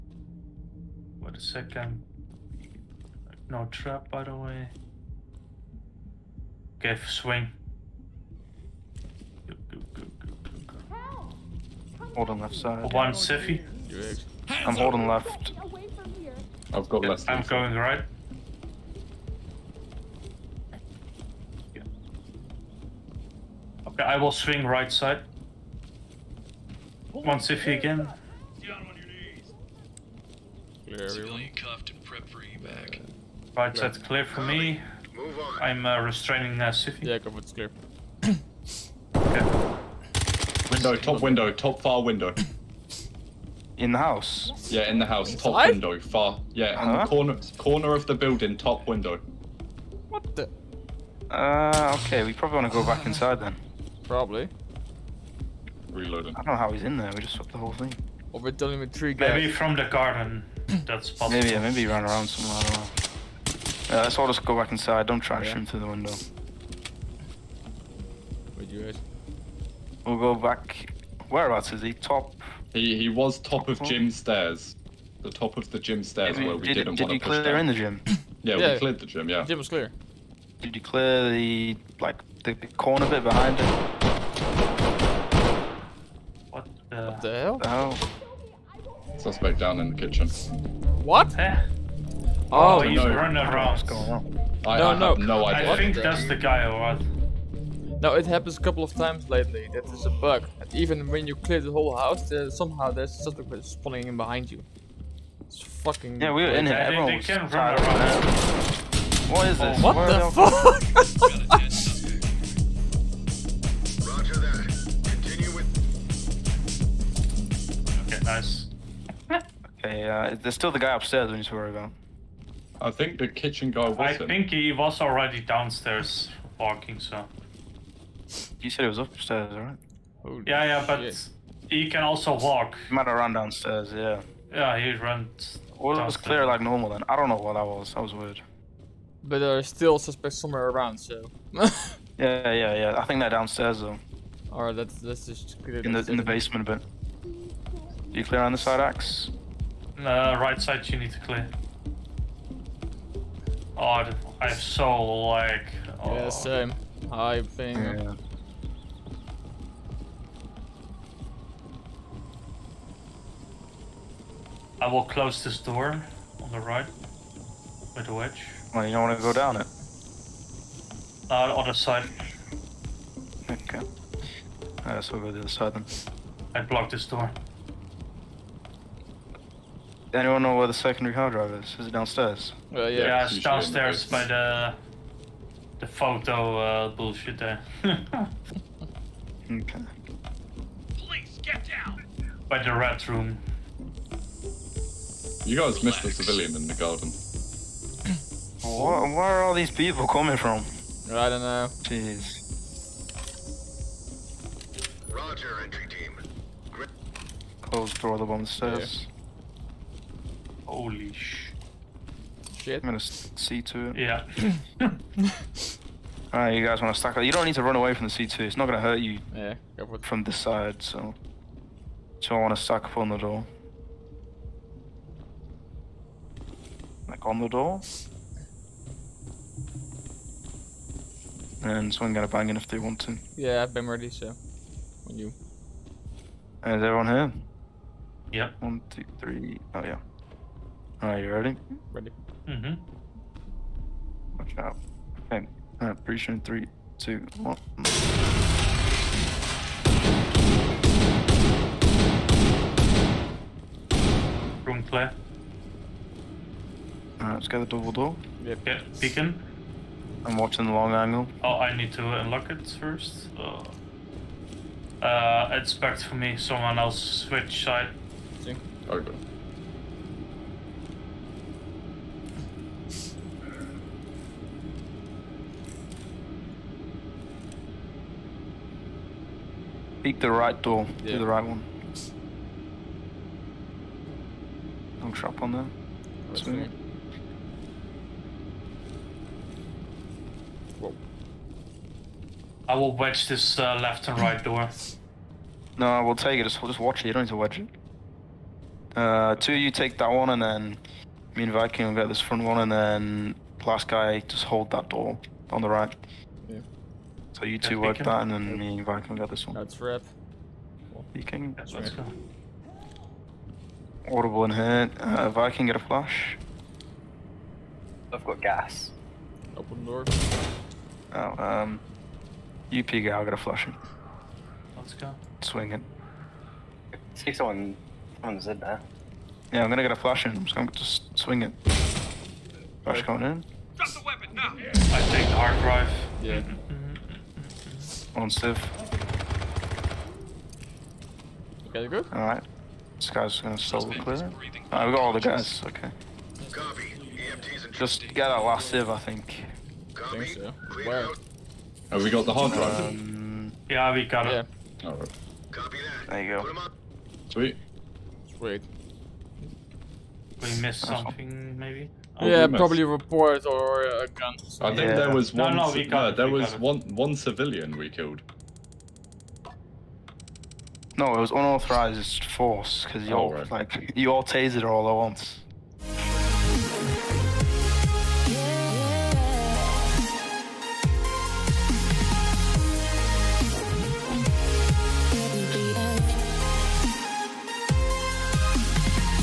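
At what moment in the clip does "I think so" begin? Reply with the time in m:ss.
5:49.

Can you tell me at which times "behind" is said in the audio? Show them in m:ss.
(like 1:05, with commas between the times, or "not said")
1:23, 1:44.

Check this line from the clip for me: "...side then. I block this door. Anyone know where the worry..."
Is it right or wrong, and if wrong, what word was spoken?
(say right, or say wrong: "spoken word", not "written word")
wrong: "secondary", not "worry".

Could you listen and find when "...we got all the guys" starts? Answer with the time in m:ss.
5:44.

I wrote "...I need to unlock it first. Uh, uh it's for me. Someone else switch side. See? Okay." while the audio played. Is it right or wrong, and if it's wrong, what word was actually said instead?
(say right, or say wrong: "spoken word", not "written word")
right.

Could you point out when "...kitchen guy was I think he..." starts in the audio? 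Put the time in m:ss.
2:03.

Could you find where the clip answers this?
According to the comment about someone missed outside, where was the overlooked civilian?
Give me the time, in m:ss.
3:16.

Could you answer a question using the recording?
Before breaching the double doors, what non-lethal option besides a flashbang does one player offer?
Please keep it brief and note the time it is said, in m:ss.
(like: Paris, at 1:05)
Gas, at 5:18.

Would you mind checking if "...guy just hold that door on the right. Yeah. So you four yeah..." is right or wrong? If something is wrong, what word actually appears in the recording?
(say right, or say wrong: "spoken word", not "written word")
wrong: "two", not "four".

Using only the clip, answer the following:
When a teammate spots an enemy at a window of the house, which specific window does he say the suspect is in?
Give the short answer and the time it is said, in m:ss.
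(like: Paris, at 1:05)
Top far window, at 0:41.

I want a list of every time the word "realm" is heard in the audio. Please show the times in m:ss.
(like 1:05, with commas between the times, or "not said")
not said.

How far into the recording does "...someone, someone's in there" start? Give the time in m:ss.
5:27.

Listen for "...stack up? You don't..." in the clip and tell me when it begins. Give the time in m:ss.
3:36.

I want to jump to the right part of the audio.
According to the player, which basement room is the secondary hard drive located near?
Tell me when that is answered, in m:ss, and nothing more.
3:12.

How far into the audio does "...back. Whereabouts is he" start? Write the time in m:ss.
1:10.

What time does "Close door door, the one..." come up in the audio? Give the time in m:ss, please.
3:27.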